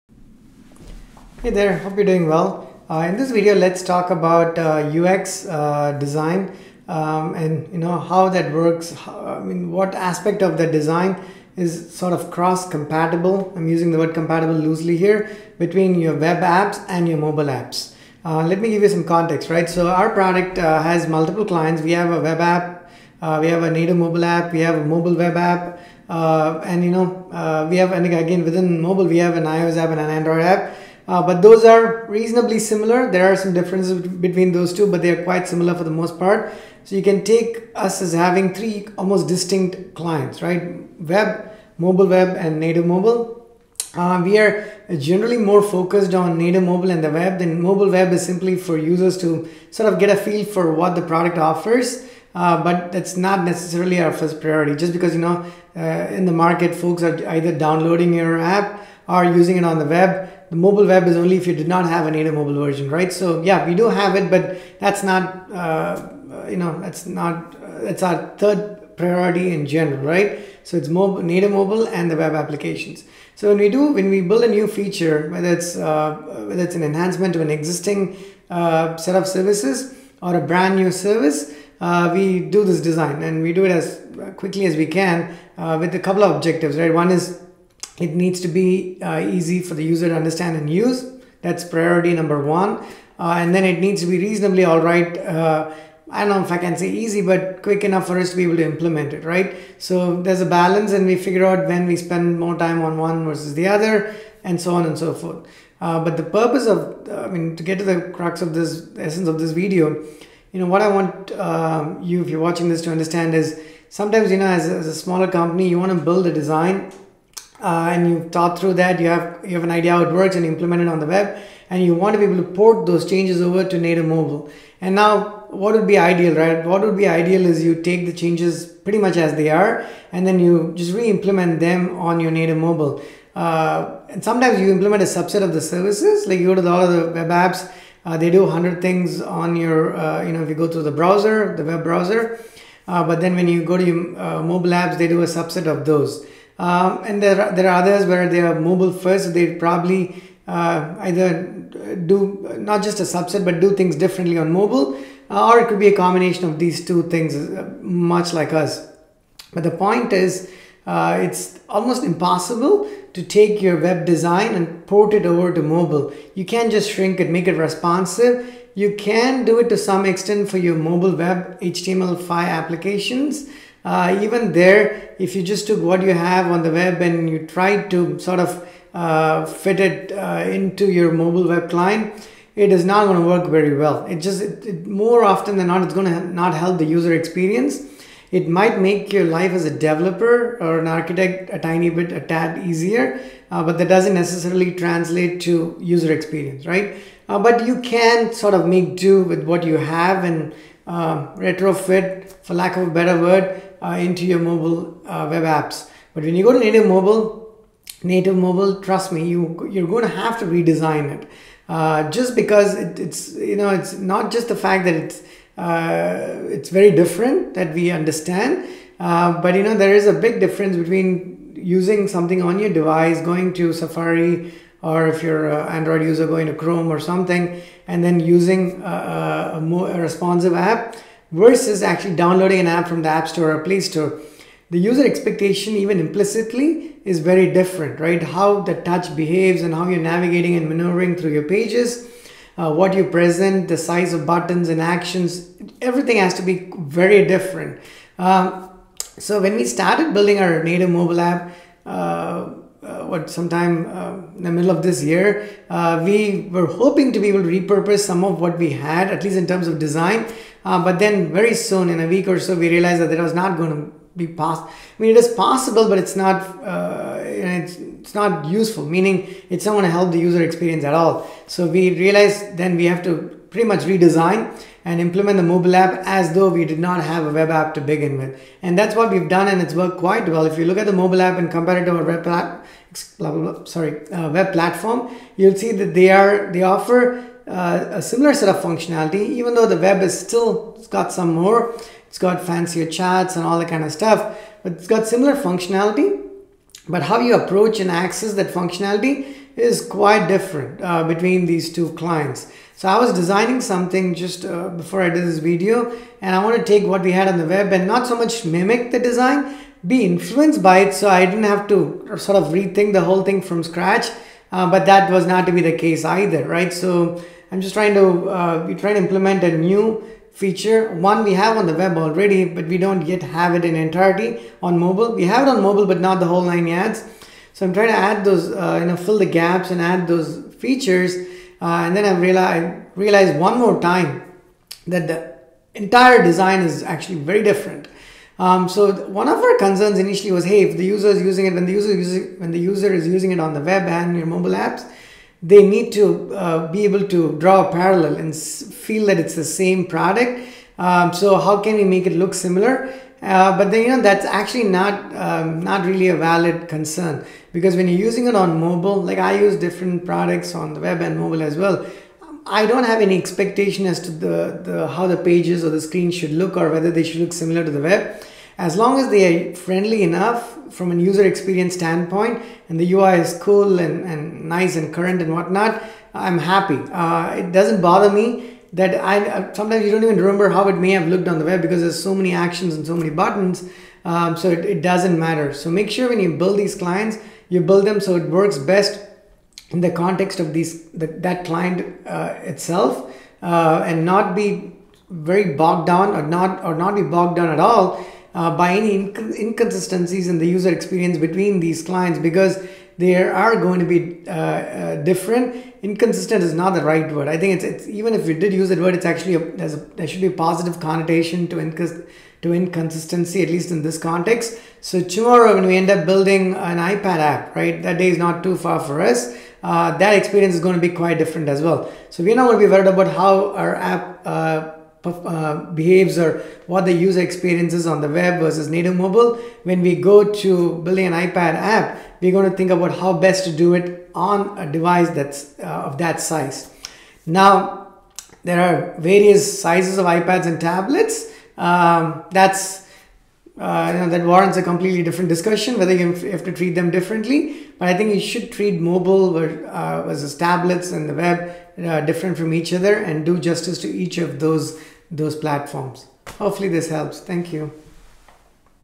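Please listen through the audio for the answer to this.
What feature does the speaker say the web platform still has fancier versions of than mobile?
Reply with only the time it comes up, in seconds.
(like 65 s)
292 s.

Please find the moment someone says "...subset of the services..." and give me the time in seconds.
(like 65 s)
135 s.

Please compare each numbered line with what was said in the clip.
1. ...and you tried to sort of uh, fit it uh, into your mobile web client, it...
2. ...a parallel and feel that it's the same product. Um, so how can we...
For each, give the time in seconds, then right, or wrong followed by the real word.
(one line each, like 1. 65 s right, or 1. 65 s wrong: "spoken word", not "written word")
1. 177 s right
2. 347 s right.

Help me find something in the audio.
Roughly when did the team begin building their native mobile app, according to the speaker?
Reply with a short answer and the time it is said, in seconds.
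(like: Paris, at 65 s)
middle of this year, at 254 s.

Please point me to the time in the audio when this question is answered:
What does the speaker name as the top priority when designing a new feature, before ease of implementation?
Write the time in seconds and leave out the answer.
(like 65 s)
89 s.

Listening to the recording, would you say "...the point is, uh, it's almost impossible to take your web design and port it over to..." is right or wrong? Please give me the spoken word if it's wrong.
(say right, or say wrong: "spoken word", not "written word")
right.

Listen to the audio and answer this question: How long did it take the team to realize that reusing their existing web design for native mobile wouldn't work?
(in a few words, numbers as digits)
a week or so.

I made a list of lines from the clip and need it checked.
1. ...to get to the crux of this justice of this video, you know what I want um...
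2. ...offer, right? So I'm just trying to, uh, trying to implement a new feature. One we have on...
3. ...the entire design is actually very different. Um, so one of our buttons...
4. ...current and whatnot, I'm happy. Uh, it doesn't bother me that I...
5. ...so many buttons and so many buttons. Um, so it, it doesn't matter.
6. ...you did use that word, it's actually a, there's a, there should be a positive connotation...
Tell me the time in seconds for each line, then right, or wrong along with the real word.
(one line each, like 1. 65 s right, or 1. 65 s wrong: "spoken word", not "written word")
1. 107 s wrong: "essence", not "justice"
2. 316 s wrong: "either", not "offer"
3. 335 s wrong: "concerns", not "buttons"
4. 374 s right
5. 382 s wrong: "actions", not "buttons"
6. 408 s right.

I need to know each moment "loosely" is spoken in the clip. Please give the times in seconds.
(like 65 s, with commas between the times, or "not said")
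14 s.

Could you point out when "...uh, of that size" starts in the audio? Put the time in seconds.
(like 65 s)
435 s.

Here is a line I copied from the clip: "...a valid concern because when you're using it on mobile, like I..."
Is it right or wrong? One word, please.
right.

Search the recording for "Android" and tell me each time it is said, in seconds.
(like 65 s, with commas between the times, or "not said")
30 s, 225 s.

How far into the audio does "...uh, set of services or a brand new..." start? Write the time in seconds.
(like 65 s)
78 s.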